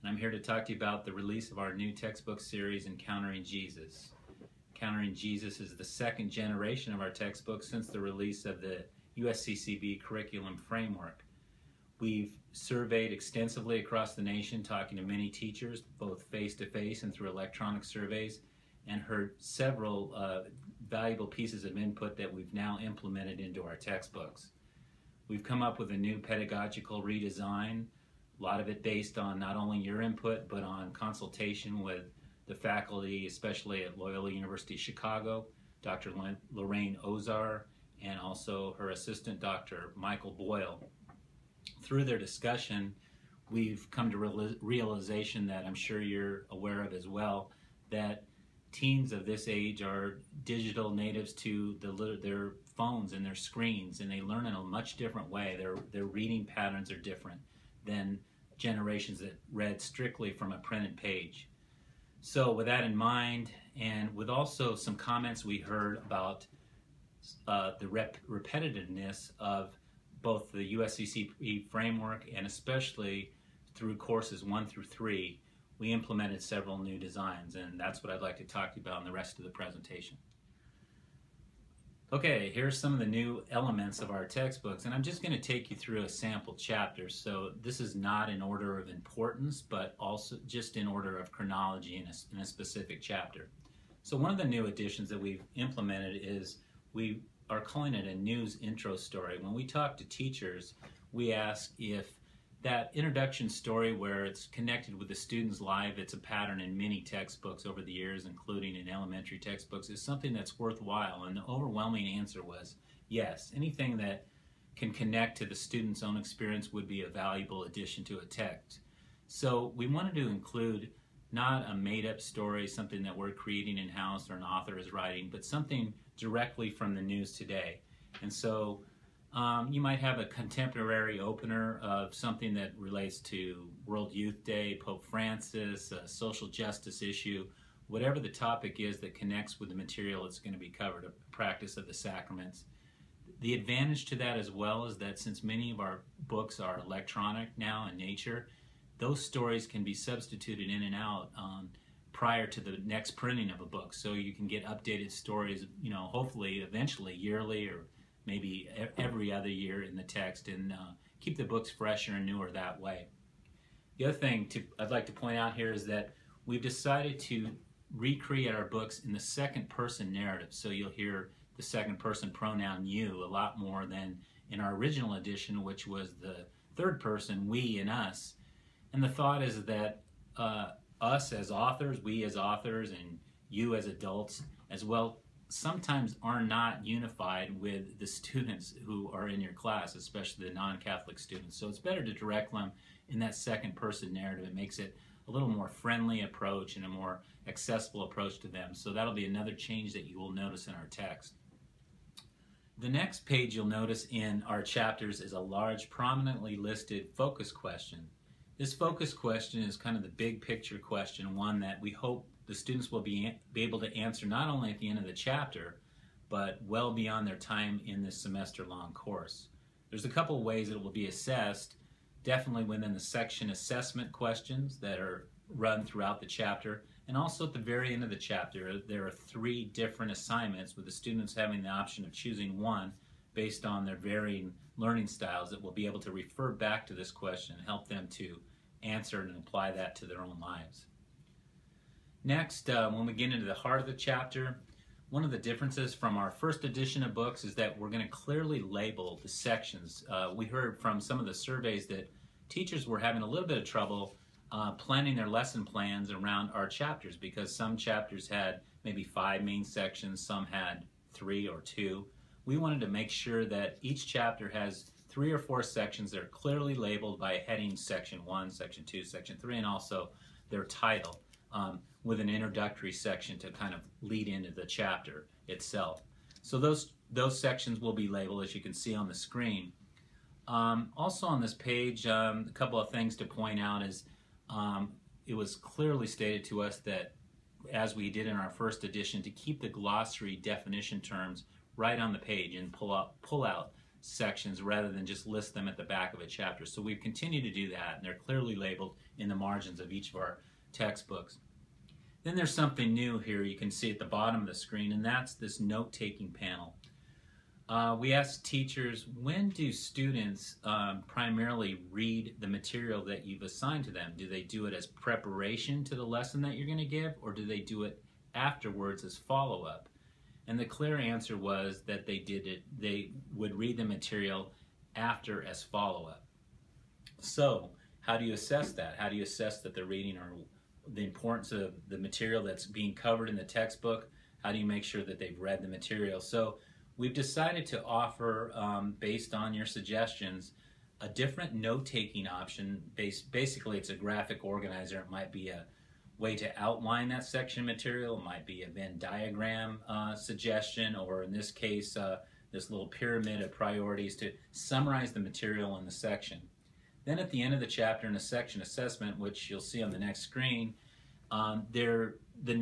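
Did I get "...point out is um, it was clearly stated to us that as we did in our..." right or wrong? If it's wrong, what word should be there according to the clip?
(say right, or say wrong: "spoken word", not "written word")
right.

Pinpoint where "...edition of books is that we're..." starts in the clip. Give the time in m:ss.
4:06.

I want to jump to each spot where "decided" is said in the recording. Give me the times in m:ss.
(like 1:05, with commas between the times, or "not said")
2:46, 5:37.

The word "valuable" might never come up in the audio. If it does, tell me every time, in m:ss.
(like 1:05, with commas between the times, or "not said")
0:20, 1:57.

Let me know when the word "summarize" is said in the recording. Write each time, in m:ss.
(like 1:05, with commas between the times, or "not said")
5:54.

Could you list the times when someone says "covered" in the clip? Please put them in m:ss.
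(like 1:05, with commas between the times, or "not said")
2:20, 5:32.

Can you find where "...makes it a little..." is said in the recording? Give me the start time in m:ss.
3:14.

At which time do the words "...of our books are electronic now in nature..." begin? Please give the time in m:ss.
2:25.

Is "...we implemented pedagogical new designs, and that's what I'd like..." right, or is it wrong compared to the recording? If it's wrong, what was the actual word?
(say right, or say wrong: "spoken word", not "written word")
wrong: "several", not "pedagogical".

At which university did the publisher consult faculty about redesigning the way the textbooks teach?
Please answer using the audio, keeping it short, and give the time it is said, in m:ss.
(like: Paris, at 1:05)
Loyola University Chicago, at 0:33.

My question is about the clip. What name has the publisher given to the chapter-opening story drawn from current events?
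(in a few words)
news intro story.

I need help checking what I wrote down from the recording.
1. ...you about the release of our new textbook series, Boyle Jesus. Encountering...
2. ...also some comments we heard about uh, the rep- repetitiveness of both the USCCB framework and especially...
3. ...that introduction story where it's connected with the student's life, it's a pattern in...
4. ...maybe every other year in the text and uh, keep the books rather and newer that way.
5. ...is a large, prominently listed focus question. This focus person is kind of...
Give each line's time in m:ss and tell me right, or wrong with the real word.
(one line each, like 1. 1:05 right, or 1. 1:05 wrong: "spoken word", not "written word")
1. 0:00 wrong: "Encountering", not "Boyle"
2. 1:04 right
3. 1:42 right
4. 2:38 wrong: "fresher", not "rather"
5. 3:25 wrong: "question", not "person".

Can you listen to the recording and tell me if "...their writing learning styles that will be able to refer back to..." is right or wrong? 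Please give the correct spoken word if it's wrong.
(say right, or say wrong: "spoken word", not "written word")
wrong: "varying", not "writing".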